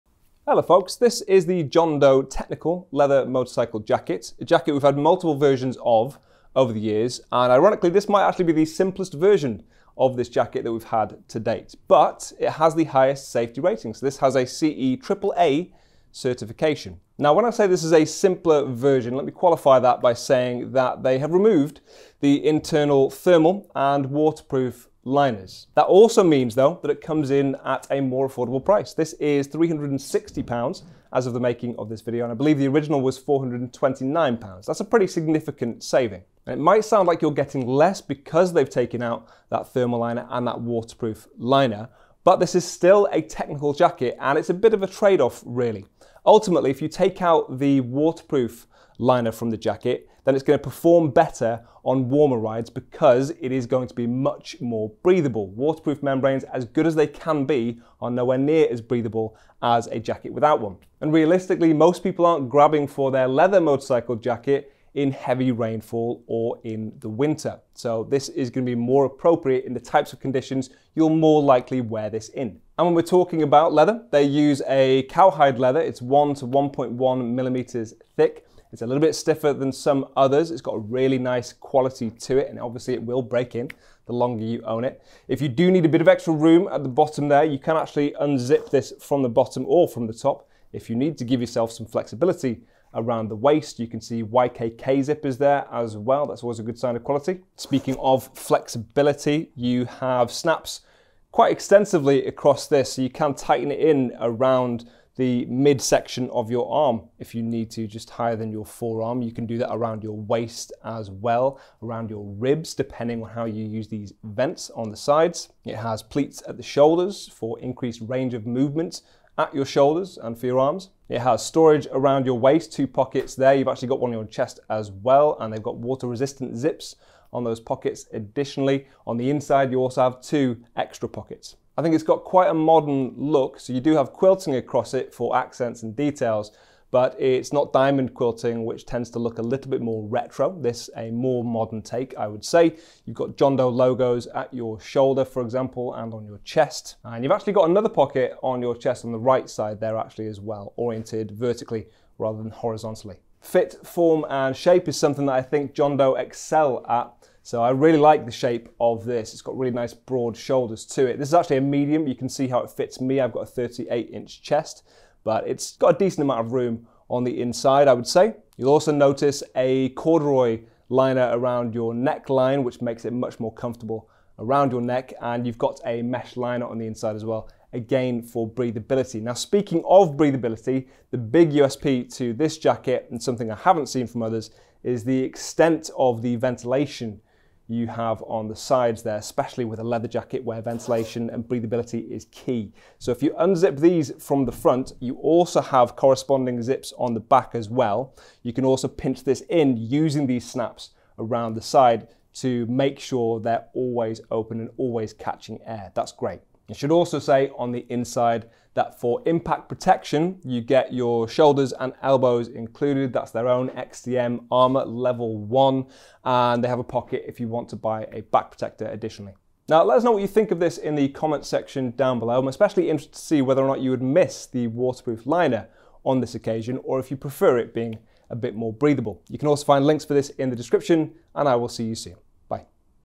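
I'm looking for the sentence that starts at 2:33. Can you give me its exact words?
Fit, form, and shape is something that I think John Doe excel at so I really like the shape of this.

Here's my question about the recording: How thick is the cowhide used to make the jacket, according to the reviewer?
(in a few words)
1 to 1.1 millimeters.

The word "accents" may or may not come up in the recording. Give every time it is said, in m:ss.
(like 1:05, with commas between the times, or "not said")
2:15.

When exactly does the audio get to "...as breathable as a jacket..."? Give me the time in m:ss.
0:58.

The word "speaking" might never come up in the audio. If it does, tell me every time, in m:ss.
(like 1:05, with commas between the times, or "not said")
1:37, 2:59.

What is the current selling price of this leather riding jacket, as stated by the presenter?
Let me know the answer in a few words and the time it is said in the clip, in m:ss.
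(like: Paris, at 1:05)
£360, at 0:29.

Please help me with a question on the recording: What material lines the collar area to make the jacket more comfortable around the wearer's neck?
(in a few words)
corduroy.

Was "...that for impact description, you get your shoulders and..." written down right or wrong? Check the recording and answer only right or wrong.
wrong.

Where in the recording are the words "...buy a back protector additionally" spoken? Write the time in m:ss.
3:37.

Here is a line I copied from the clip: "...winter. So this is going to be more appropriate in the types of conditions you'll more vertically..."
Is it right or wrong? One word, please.
wrong.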